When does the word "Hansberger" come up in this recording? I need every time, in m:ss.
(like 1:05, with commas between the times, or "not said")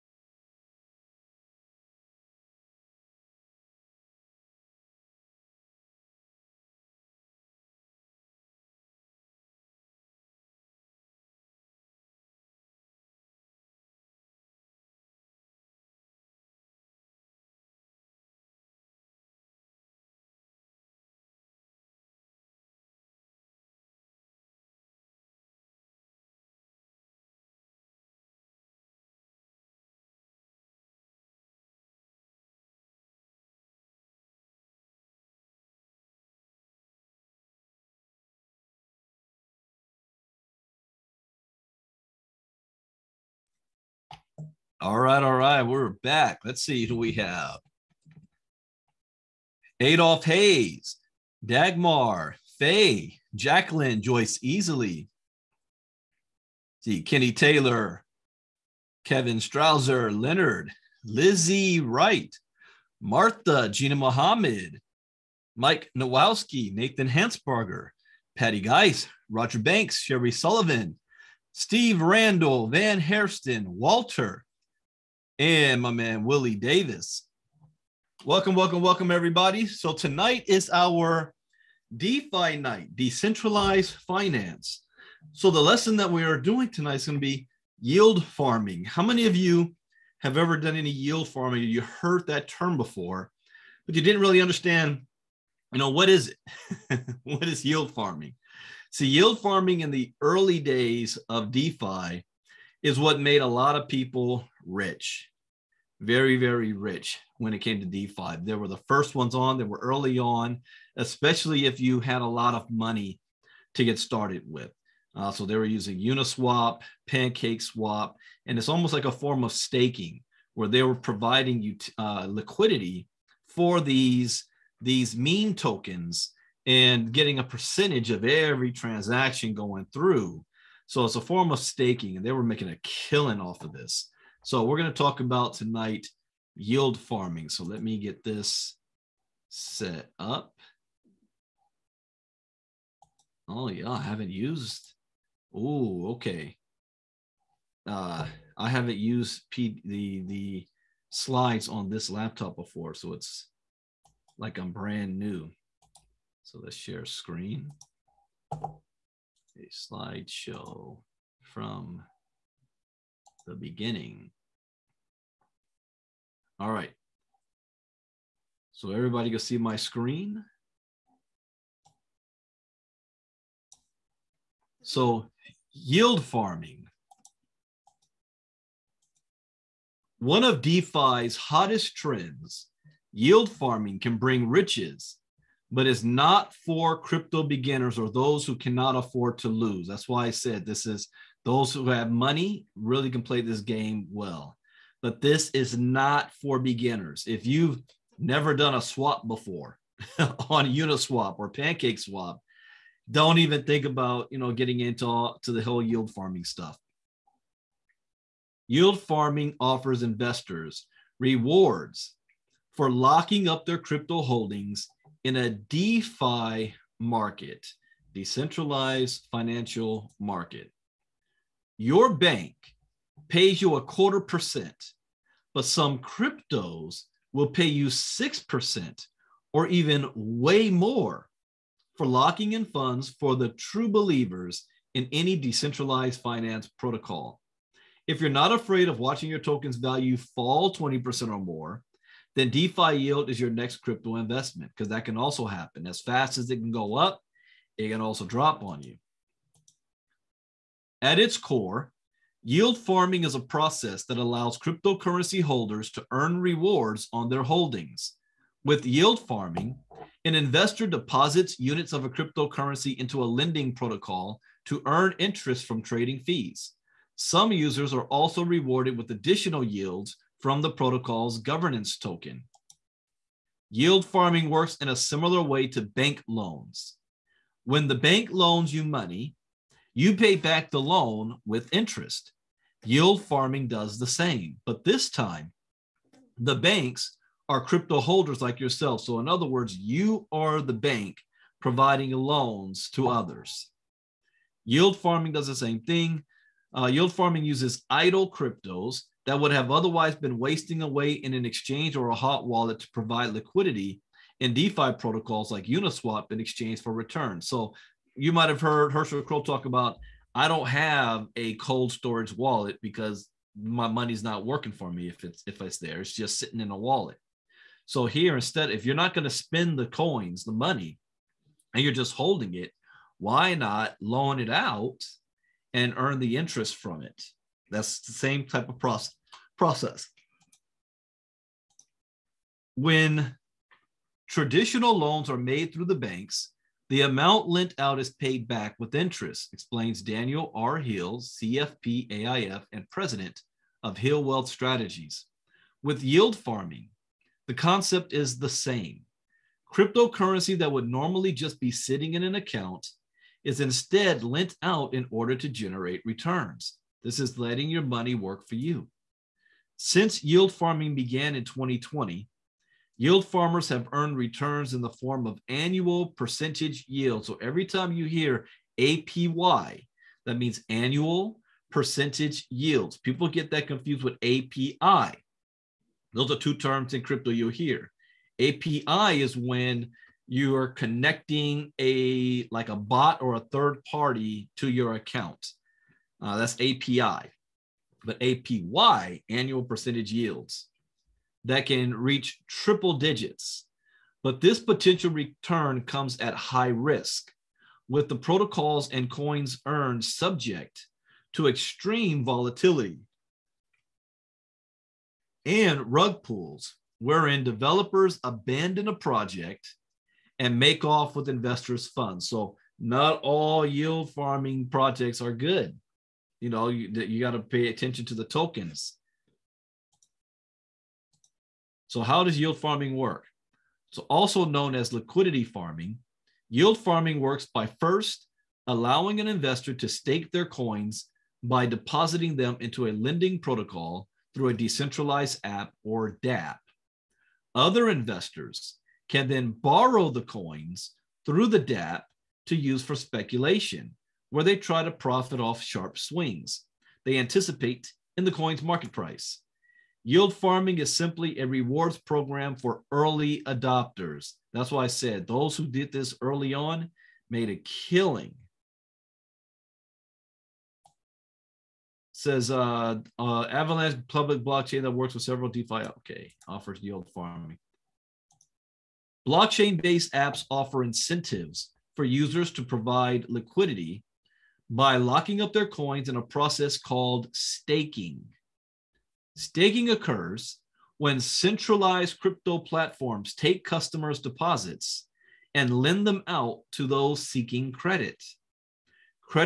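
1:07.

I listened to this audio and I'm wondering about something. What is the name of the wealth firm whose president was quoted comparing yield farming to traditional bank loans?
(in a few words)
Hill Wealth Strategies.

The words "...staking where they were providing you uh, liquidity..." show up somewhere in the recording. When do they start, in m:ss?
1:59.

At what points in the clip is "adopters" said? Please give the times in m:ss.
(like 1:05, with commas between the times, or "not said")
7:33.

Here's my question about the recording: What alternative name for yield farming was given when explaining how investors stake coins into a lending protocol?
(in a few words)
liquidity farming.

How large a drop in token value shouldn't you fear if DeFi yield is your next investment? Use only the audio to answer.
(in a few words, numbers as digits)
20%.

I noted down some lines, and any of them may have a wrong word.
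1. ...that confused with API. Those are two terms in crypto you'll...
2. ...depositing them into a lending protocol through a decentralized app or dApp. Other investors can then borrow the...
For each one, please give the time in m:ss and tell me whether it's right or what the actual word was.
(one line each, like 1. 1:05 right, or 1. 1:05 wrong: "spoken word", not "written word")
1. 6:13 right
2. 7:11 right.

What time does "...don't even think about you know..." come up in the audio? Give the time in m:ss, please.
3:23.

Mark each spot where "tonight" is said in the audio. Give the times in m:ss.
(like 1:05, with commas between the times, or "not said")
1:19, 1:26, 2:15.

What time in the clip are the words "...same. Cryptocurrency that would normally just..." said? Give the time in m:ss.
5:48.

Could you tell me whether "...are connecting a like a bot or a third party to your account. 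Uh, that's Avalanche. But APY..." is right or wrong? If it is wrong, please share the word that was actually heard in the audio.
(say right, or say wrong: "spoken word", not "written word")
wrong: "API", not "Avalanche".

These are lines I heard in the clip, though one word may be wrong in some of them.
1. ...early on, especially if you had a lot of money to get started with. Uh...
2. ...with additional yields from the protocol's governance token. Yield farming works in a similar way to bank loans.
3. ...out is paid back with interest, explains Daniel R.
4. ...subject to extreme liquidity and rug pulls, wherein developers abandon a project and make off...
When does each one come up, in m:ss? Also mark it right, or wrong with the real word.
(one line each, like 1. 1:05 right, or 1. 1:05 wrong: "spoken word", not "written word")
1. 1:49 right
2. 4:28 right
3. 5:37 right
4. 6:40 wrong: "volatility", not "liquidity".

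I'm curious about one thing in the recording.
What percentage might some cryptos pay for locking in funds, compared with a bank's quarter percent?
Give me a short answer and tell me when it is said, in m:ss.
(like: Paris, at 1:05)
6%, at 3:47.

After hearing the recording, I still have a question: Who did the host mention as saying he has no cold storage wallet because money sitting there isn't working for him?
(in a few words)
Herschel Kroll.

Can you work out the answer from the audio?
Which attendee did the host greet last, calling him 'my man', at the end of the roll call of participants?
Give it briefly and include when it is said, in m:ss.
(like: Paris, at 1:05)
Willie Davis, at 1:16.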